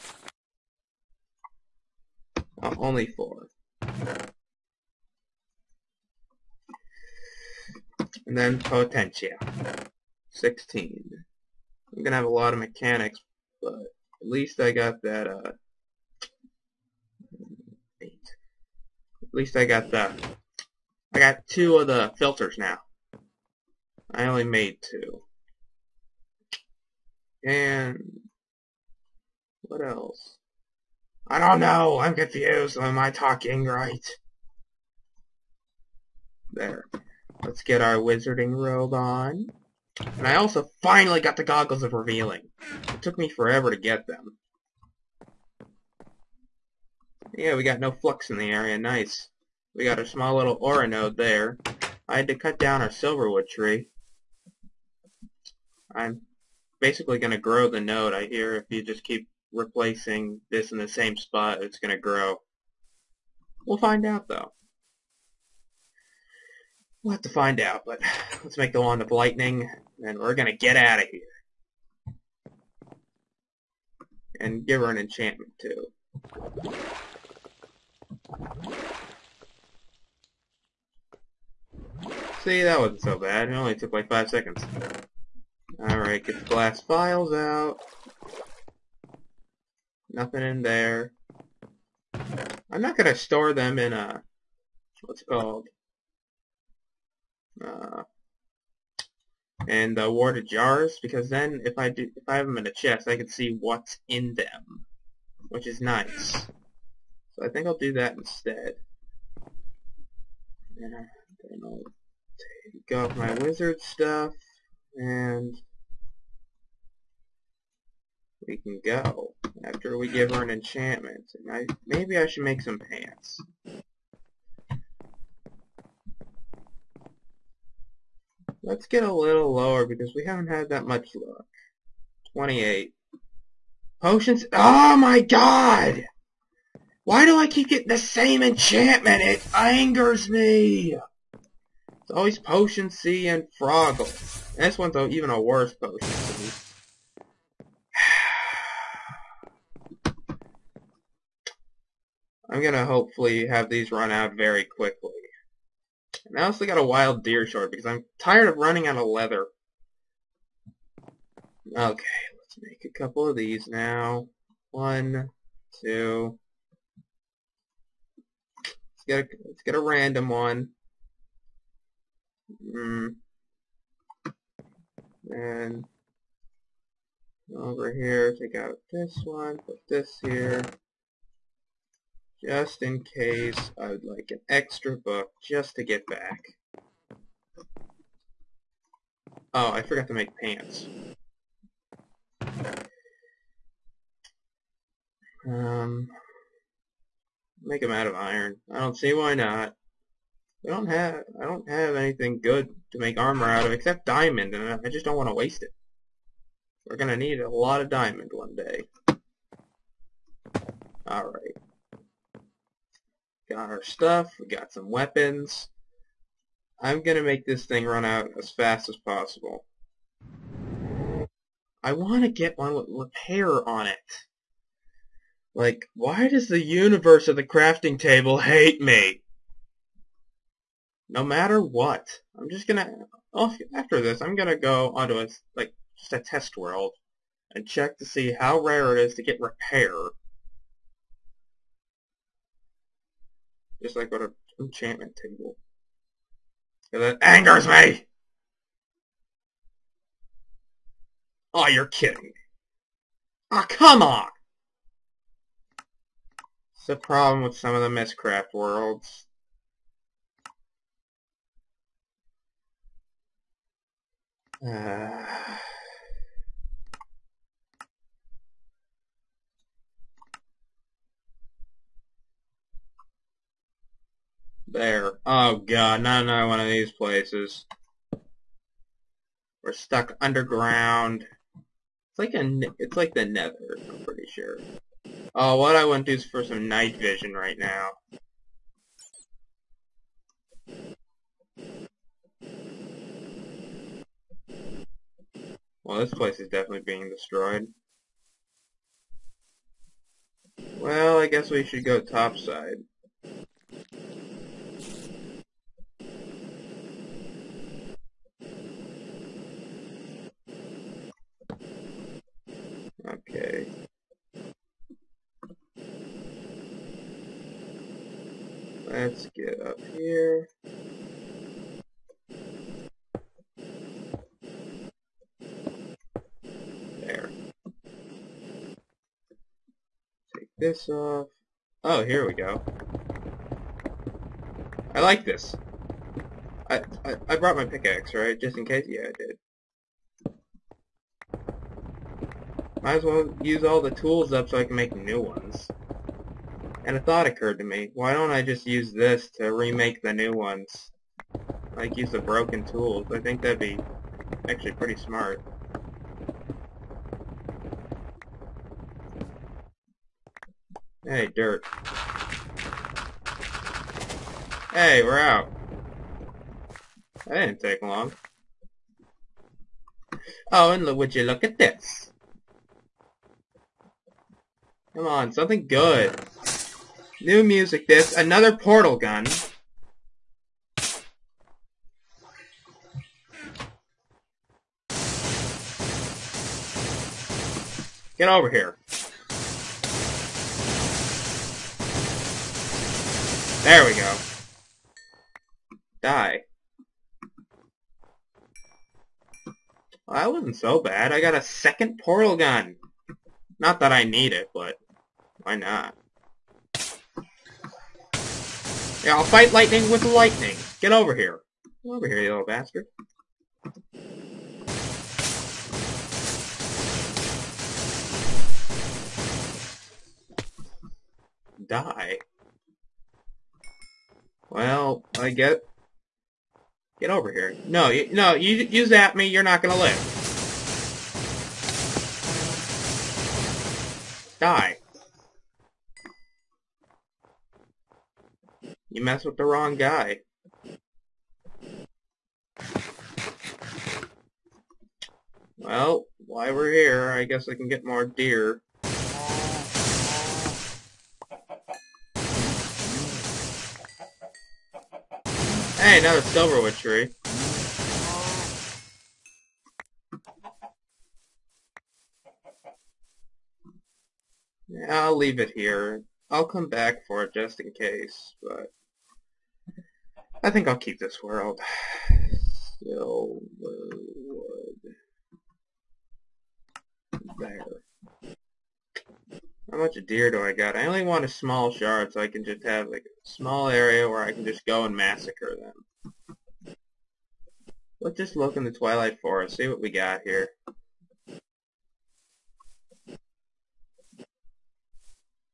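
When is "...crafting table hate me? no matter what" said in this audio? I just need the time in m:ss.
3:47.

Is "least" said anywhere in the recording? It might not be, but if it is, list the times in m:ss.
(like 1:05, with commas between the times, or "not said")
0:14, 0:19.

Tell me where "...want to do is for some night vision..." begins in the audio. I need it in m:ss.
4:45.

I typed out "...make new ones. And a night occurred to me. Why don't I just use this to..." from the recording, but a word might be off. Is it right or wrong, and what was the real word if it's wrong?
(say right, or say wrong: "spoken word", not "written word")
wrong: "thought", not "night".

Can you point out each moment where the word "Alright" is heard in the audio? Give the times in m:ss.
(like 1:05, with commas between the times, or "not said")
1:25, 3:31.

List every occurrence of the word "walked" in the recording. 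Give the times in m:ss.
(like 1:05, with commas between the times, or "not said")
not said.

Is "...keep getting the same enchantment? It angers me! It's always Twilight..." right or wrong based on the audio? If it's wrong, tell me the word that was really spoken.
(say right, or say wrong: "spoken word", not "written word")
wrong: "Potion", not "Twilight".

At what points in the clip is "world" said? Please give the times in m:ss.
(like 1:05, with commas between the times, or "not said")
3:56, 4:18, 7:51.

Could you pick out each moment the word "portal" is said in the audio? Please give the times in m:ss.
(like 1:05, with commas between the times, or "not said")
6:18, 6:41.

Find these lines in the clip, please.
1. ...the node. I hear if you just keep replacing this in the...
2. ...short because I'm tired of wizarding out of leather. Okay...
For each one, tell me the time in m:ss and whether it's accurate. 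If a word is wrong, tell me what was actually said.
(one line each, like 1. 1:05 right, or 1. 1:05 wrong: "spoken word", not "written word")
1. 0:57 right
2. 2:37 wrong: "running", not "wizarding".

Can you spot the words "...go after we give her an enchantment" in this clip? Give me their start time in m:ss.
1:58.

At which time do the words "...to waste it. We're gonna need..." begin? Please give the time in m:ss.
3:25.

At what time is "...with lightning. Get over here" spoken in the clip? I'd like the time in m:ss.
6:49.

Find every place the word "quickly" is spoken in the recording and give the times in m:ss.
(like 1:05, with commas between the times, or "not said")
2:34.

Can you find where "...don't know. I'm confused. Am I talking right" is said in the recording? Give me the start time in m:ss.
0:31.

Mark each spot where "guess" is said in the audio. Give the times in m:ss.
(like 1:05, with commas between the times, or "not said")
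5:01, 7:27.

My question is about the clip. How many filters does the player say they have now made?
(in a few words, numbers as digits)
2.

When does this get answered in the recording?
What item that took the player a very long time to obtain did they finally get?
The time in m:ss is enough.
0:41.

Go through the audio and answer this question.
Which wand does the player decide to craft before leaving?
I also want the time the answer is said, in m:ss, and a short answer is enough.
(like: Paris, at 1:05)
Wand of lightning, at 1:08.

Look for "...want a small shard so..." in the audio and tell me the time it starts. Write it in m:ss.
8:01.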